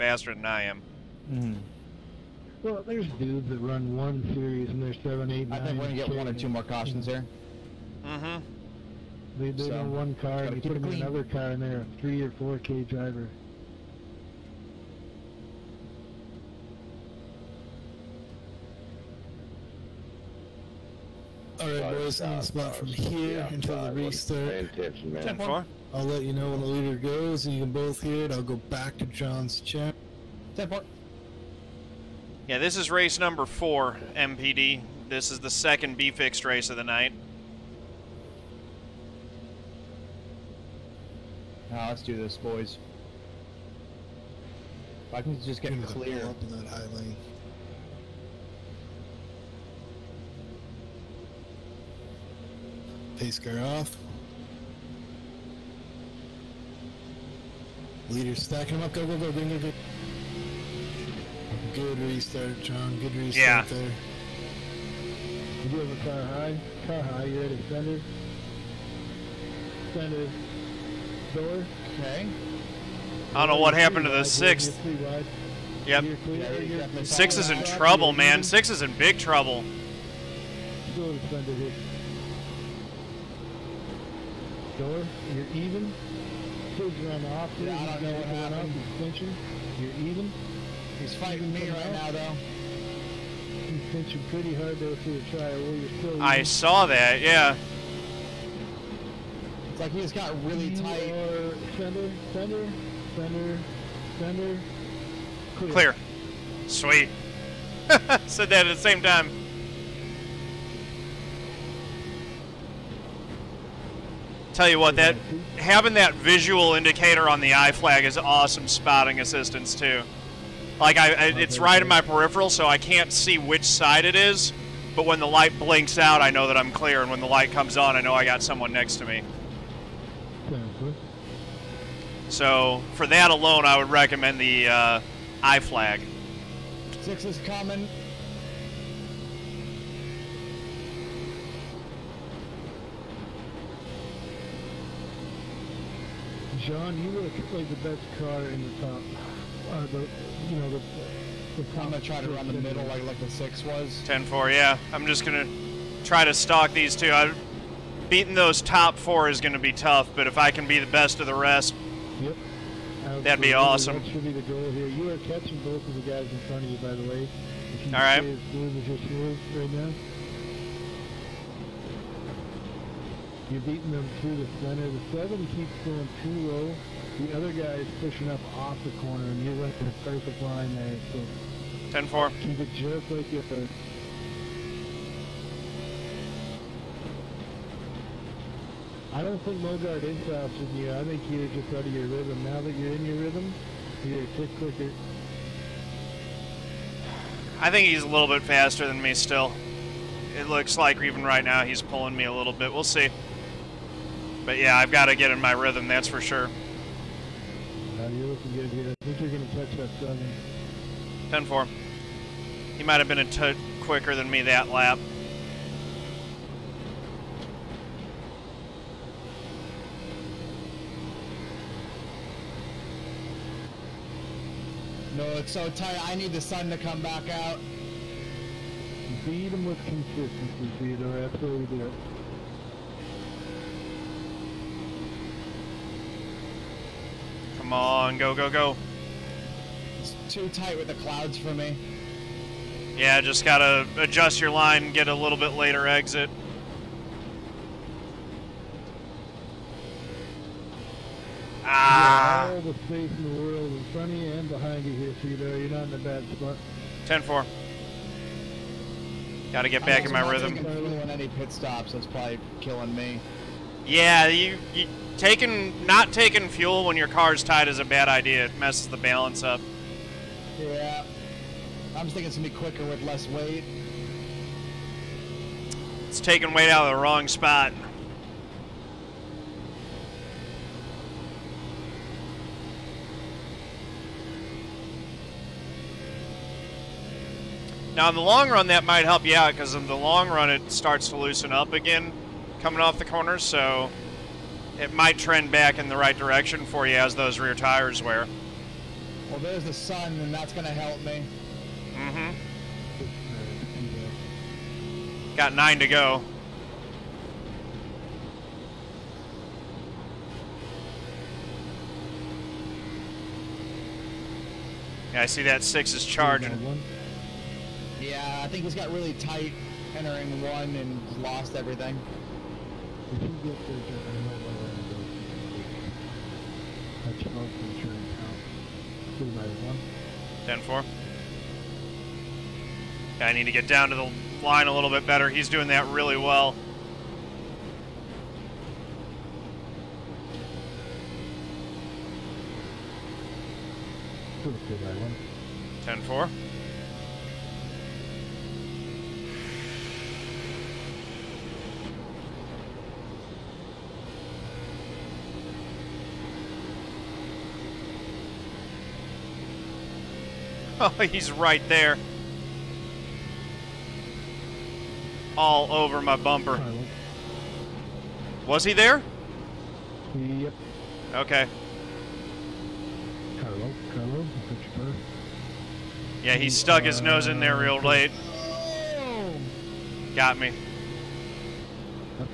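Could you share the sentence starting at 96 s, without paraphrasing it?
I saw that, yeah like he just got really you tight.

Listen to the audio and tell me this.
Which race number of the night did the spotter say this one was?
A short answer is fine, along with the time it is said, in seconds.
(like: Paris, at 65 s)
4, at 32 s.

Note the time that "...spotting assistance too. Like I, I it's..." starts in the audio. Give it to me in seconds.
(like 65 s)
118 s.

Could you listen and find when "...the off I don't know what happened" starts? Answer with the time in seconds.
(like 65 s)
87 s.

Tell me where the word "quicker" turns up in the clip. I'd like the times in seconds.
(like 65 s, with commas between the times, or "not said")
194 s, 213 s, 272 s.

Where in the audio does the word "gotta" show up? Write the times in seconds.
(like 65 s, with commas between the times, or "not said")
243 s, 259 s.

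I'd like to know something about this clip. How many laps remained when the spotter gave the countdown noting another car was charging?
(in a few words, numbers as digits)
9.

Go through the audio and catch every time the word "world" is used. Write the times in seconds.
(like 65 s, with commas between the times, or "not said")
253 s.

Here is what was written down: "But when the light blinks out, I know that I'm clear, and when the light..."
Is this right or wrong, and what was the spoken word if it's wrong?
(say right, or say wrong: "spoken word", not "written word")
right.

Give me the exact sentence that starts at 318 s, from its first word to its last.
Yeah, I think he's got really tight entering one and lost everything.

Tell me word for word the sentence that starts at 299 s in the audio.
Well, there's the sun, and that's going to help me.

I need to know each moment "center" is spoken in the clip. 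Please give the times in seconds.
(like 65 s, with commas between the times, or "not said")
174 s.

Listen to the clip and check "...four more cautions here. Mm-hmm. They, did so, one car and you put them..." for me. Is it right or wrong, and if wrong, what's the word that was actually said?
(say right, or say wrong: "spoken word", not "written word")
wrong: "two", not "four".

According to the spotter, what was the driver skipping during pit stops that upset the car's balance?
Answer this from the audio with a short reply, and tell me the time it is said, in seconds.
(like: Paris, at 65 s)
fuel, at 265 s.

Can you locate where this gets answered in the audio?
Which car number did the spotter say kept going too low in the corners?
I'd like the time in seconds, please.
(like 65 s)
174 s.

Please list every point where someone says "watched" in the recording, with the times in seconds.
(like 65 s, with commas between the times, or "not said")
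not said.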